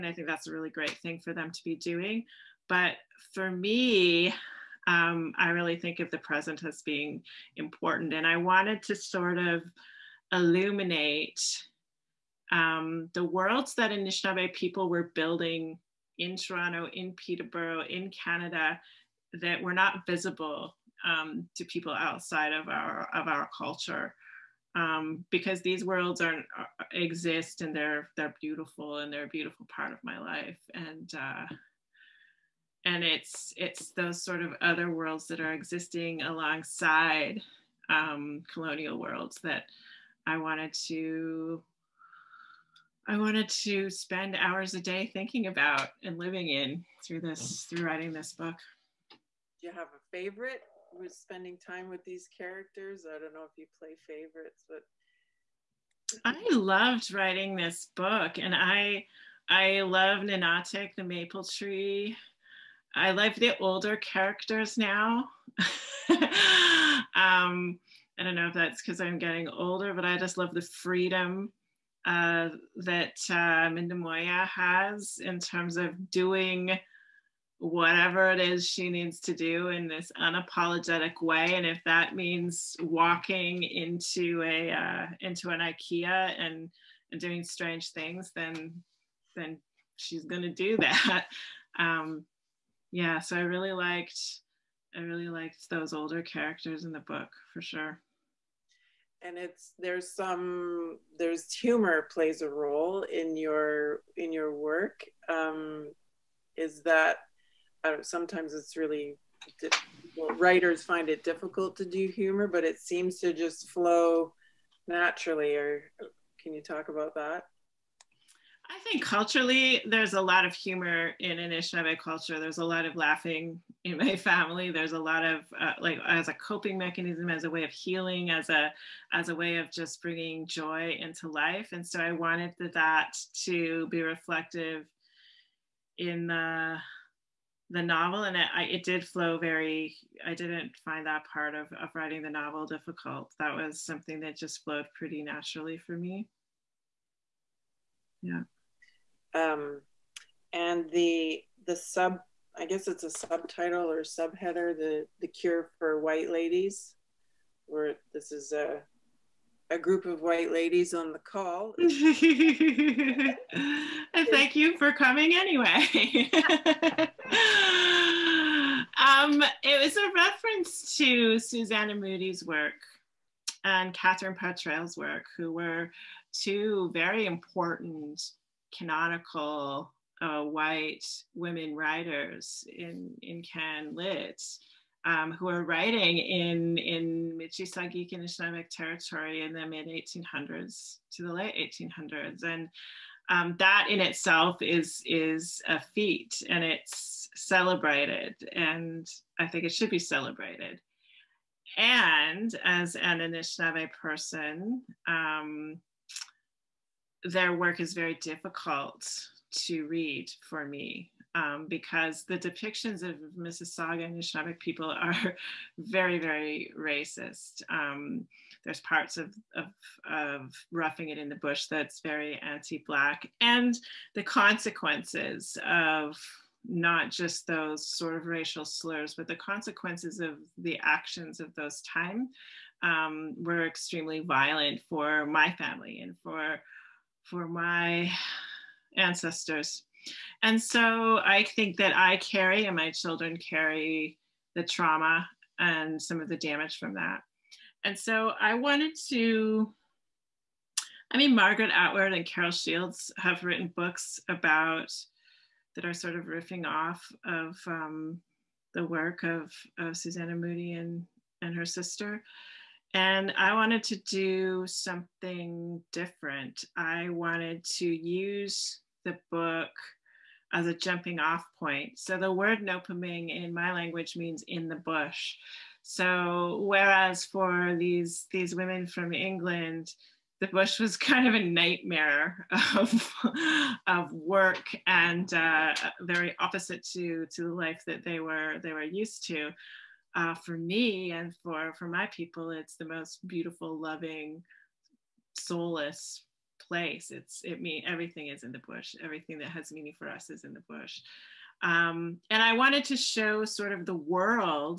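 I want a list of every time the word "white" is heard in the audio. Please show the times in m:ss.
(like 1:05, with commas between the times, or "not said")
2:35, 2:40, 3:00.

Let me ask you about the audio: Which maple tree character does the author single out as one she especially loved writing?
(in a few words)
Ninaatig.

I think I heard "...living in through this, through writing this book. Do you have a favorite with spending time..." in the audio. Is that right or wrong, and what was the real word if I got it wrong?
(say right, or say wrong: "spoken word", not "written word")
right.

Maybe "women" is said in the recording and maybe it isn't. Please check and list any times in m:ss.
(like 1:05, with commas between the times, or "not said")
3:01, 4:38.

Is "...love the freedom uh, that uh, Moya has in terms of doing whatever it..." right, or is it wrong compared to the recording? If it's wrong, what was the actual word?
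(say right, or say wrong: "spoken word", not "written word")
right.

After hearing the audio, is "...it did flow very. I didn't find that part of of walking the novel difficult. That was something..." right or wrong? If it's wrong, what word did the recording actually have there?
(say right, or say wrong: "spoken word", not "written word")
wrong: "writing", not "walking".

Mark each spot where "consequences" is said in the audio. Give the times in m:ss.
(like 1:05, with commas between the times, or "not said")
3:44, 3:49.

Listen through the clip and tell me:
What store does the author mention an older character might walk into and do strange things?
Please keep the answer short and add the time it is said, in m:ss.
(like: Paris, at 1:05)
IKEA, at 1:25.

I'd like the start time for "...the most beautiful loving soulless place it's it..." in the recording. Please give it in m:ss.
4:52.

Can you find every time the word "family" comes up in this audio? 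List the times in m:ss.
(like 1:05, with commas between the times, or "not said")
2:04, 3:55.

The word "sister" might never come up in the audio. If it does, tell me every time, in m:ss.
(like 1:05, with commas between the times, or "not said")
4:21.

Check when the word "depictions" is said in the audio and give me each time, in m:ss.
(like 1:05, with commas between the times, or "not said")
3:32.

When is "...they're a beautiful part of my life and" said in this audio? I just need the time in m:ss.
0:29.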